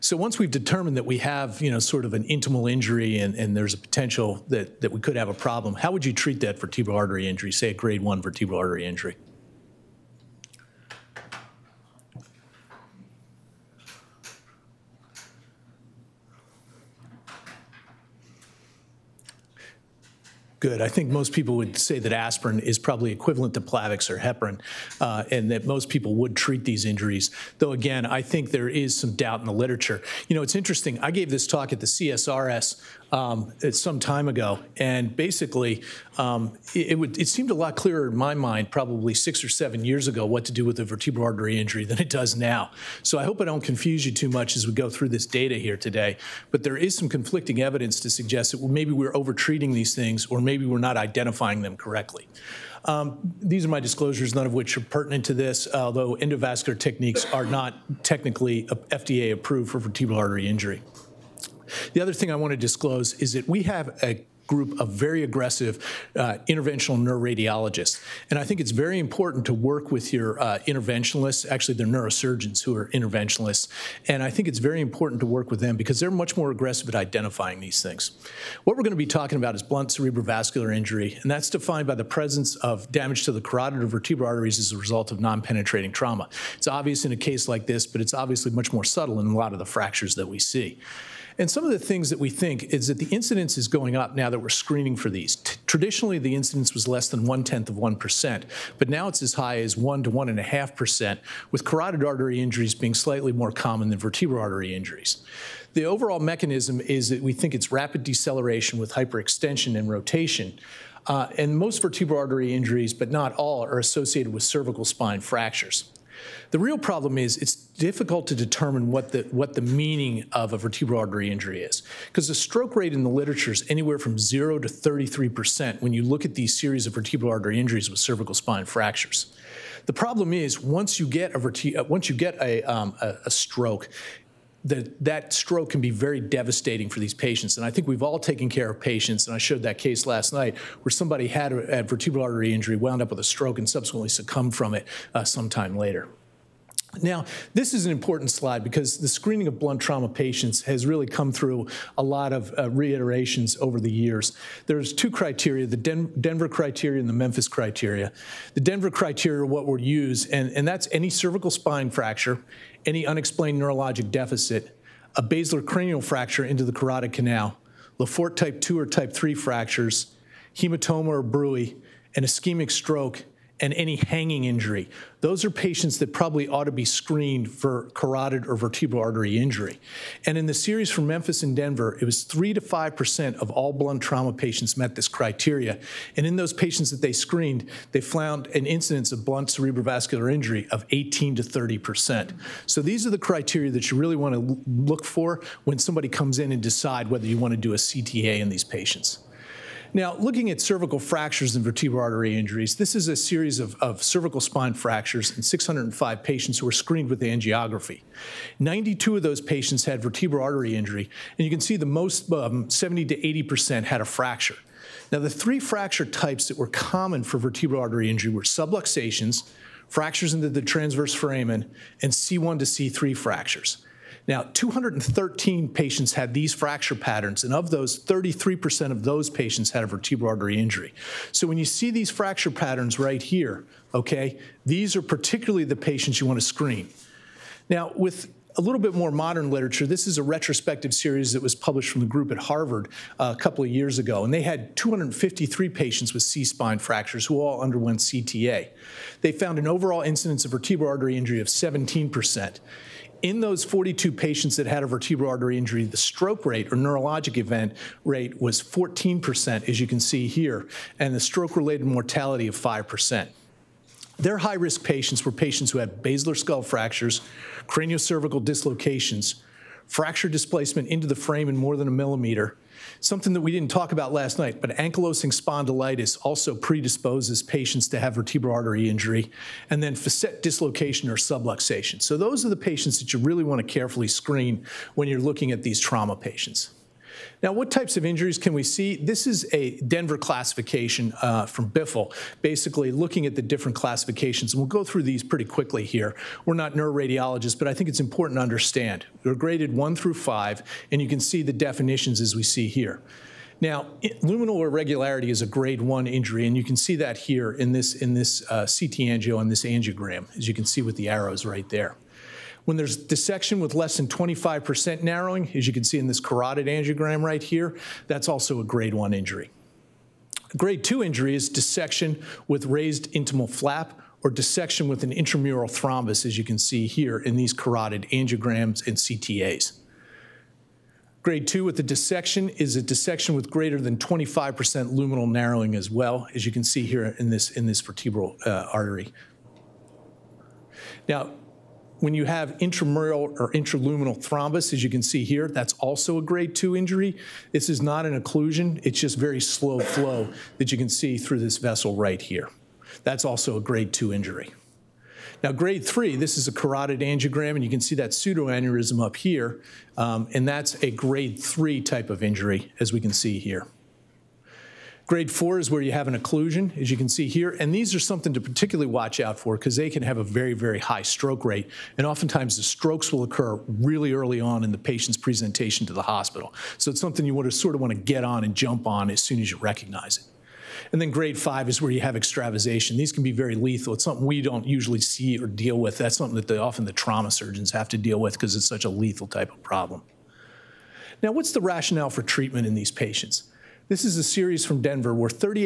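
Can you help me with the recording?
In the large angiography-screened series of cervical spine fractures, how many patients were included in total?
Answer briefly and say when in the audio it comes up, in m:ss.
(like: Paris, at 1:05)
605, at 3:25.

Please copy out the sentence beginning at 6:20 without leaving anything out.
And then grade five is where you have extravasation.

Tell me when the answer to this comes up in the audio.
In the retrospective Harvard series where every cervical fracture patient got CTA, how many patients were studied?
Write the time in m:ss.
4:04.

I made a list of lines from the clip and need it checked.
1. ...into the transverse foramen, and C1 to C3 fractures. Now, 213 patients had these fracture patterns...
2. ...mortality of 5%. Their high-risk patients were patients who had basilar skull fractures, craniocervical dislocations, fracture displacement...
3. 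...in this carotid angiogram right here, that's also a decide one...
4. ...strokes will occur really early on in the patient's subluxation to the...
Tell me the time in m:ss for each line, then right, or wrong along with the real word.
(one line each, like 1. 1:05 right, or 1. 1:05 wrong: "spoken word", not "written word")
1. 3:40 right
2. 4:21 right
3. 5:15 wrong: "grade", not "decide"
4. 6:12 wrong: "presentation", not "subluxation".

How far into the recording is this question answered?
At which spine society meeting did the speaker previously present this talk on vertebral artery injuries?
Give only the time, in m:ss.
0:31.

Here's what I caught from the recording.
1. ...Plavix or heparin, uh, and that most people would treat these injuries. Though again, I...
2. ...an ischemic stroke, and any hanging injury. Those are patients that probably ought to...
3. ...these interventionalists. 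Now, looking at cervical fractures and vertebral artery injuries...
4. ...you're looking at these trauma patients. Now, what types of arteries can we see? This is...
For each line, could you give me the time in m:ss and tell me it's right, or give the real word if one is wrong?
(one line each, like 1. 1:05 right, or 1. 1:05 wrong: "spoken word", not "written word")
1. 0:23 right
2. 2:52 right
3. 3:18 wrong: "patients", not "interventionalists"
4. 4:45 wrong: "injuries", not "arteries".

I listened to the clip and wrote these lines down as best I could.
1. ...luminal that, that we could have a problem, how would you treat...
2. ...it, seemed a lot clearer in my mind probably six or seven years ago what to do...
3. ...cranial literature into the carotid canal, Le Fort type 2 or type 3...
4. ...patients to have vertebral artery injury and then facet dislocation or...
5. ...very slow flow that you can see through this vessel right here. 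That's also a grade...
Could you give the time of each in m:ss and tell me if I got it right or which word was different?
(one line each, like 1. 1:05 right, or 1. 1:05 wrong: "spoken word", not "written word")
1. 0:03 wrong: "potential", not "luminal"
2. 0:37 right
3. 2:45 wrong: "fracture", not "literature"
4. 4:37 right
5. 5:49 right.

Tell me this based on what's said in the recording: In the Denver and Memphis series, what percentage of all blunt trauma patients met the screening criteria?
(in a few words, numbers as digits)
3 to 5%.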